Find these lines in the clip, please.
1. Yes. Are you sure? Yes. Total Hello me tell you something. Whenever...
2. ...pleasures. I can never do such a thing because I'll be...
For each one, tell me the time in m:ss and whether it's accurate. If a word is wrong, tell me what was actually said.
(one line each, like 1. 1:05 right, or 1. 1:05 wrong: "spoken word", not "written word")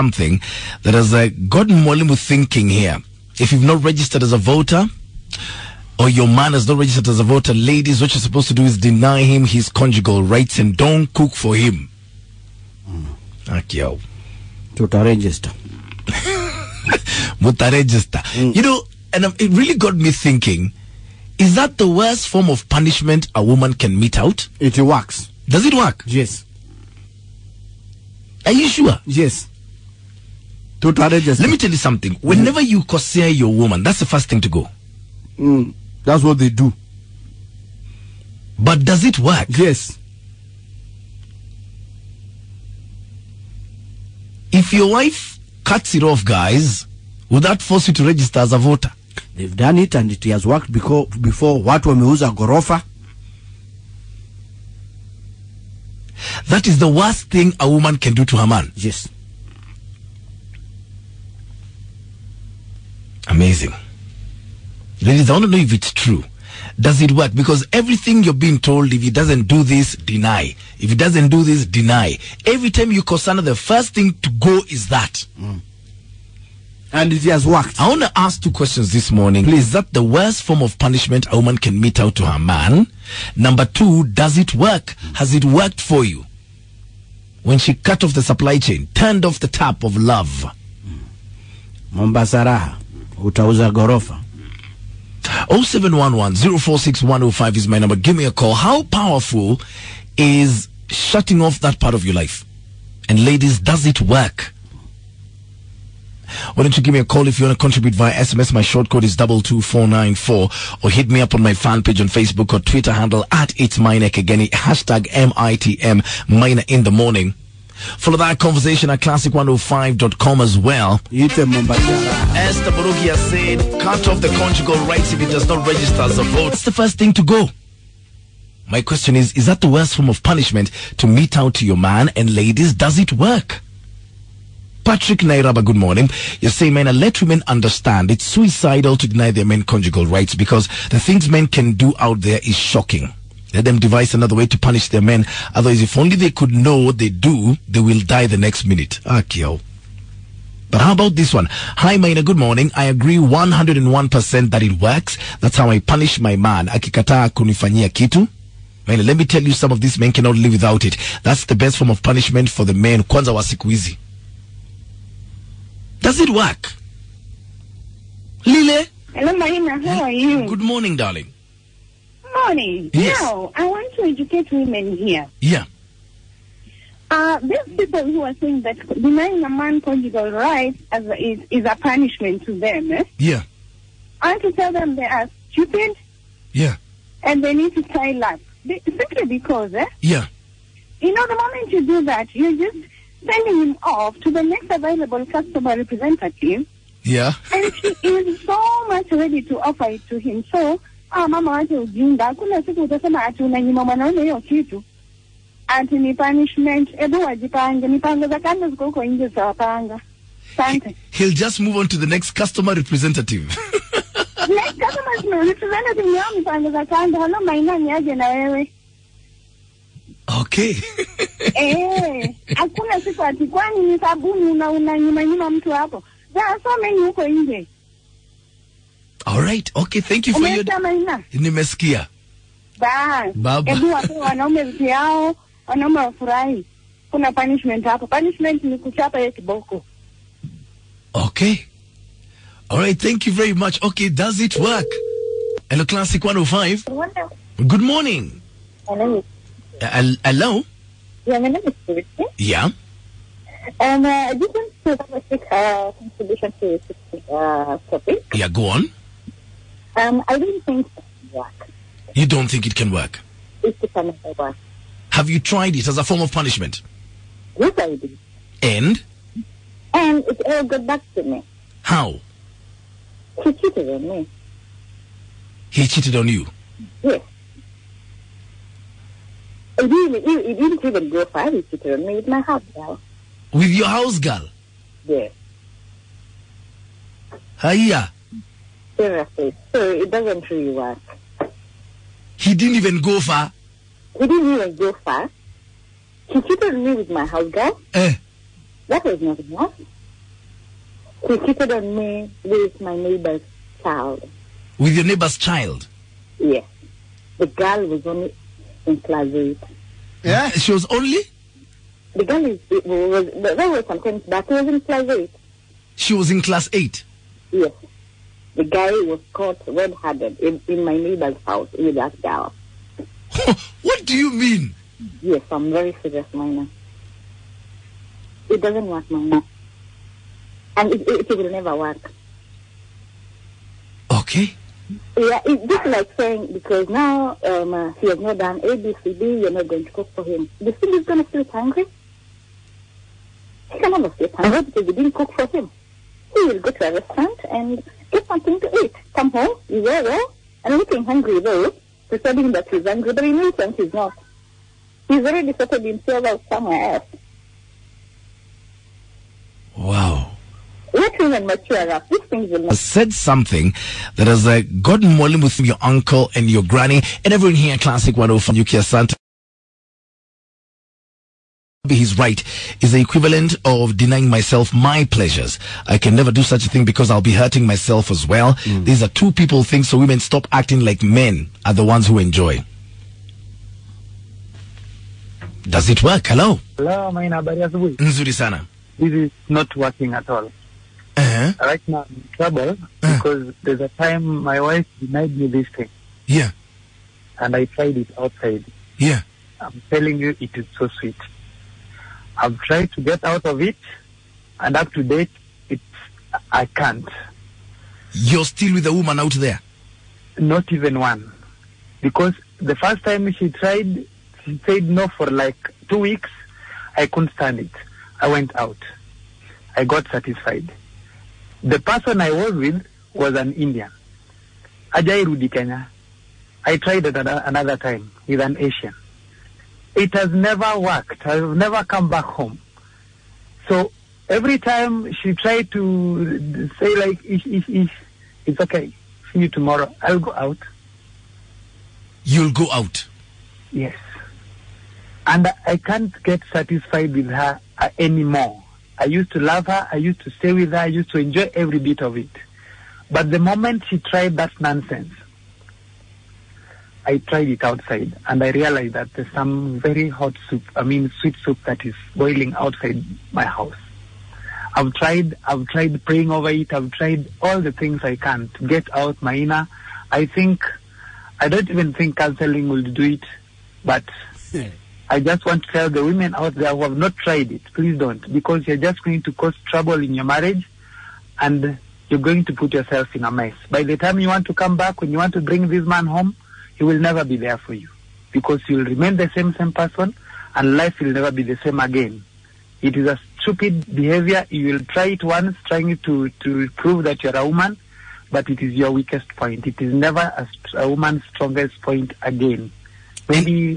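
1. 0:26 wrong: "Let", not "Hello"
2. 6:15 right.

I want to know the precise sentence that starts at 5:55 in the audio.
He's already sorted himself out somewhere else.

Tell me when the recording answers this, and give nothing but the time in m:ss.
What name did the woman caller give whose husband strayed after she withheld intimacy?
4:11.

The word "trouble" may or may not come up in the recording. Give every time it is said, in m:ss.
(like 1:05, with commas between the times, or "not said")
6:32, 7:59.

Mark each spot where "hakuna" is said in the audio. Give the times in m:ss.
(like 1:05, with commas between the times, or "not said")
3:22, 3:42.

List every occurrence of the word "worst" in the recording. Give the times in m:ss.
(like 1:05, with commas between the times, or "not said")
0:21, 0:56, 1:20, 2:09.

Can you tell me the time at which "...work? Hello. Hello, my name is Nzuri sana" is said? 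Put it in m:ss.
6:26.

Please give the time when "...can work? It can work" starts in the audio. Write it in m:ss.
4:22.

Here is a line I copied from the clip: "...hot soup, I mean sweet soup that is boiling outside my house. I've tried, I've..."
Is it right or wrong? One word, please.
right.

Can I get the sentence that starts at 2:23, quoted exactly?
Let them devise another way to punish their men.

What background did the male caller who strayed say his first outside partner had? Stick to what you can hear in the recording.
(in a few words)
Indian.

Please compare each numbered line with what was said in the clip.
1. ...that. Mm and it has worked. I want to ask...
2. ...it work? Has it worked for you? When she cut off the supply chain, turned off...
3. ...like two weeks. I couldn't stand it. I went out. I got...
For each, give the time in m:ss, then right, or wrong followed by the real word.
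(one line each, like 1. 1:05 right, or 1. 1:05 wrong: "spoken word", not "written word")
1. 1:14 right
2. 1:24 right
3. 6:55 right.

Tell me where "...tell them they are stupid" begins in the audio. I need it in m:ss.
3:04.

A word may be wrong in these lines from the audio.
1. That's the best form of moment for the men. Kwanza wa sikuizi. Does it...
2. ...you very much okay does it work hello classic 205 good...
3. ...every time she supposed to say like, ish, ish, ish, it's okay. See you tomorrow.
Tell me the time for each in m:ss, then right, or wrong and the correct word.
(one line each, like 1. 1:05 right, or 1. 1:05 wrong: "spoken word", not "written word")
1. 2:41 wrong: "punishment", not "moment"
2. 4:03 wrong: "105", not "205"
3. 7:14 wrong: "tried", not "supposed".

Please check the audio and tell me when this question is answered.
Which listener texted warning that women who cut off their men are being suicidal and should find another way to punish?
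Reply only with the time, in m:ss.
2:14.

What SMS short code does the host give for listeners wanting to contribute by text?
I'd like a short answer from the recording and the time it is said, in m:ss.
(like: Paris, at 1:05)
22494, at 1:49.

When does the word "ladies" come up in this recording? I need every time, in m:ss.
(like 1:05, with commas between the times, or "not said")
0:07, 1:05, 1:43, 2:12.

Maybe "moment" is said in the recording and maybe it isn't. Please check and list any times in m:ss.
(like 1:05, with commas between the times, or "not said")
3:11, 7:33.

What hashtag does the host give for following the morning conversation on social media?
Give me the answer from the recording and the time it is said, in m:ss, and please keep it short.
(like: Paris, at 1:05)
MITM, at 1:55.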